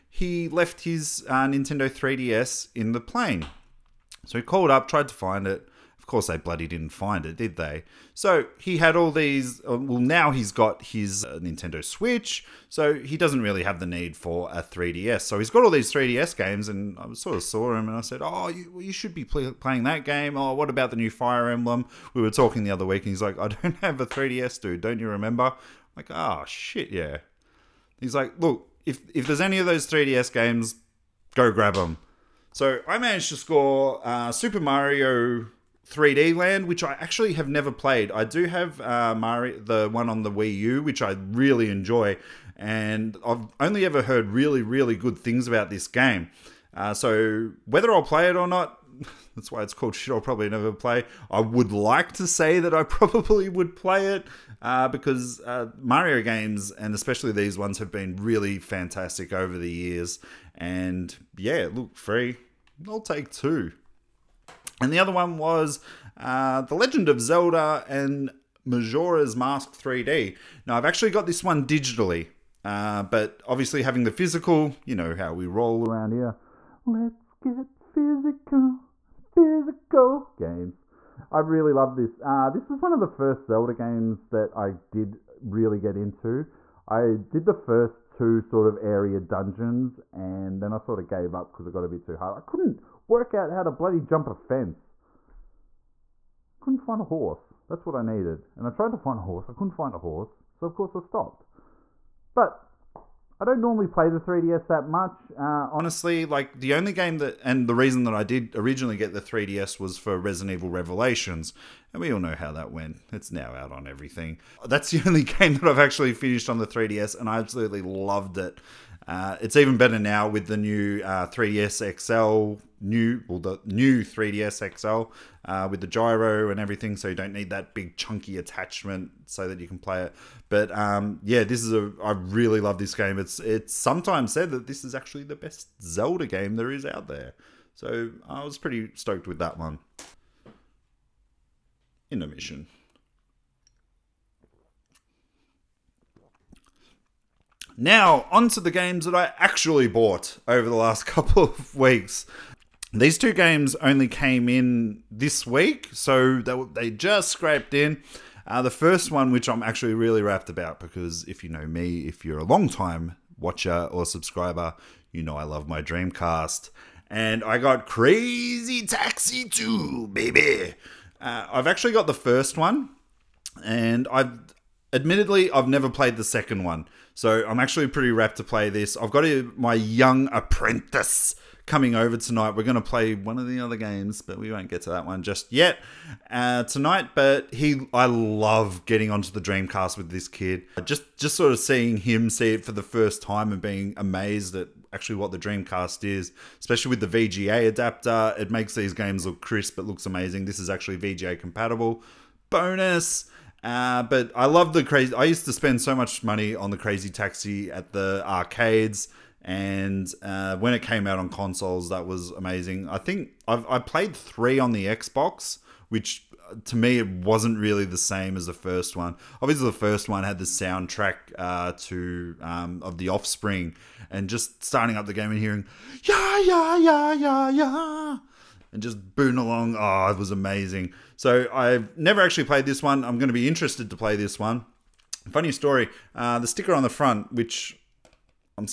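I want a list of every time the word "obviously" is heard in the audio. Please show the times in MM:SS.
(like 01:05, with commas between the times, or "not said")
01:13, 03:39.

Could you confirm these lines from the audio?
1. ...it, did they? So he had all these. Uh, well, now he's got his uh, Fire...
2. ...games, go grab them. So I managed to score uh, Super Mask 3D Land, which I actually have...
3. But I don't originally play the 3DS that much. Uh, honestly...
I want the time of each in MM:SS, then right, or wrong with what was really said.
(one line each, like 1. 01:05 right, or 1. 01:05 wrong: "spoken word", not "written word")
1. 00:07 wrong: "Nintendo", not "Fire"
2. 00:30 wrong: "Mario", not "Mask"
3. 01:42 wrong: "normally", not "originally".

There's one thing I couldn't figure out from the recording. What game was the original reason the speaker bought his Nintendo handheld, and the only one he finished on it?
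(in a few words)
Resident Evil Revelations.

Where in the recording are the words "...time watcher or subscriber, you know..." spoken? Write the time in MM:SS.
02:42.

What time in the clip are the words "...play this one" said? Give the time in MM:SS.
03:53.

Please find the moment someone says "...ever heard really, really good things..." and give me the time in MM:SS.
00:43.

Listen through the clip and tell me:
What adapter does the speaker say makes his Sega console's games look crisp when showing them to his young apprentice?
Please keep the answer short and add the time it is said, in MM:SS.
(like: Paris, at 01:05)
VGA adapter, at 03:17.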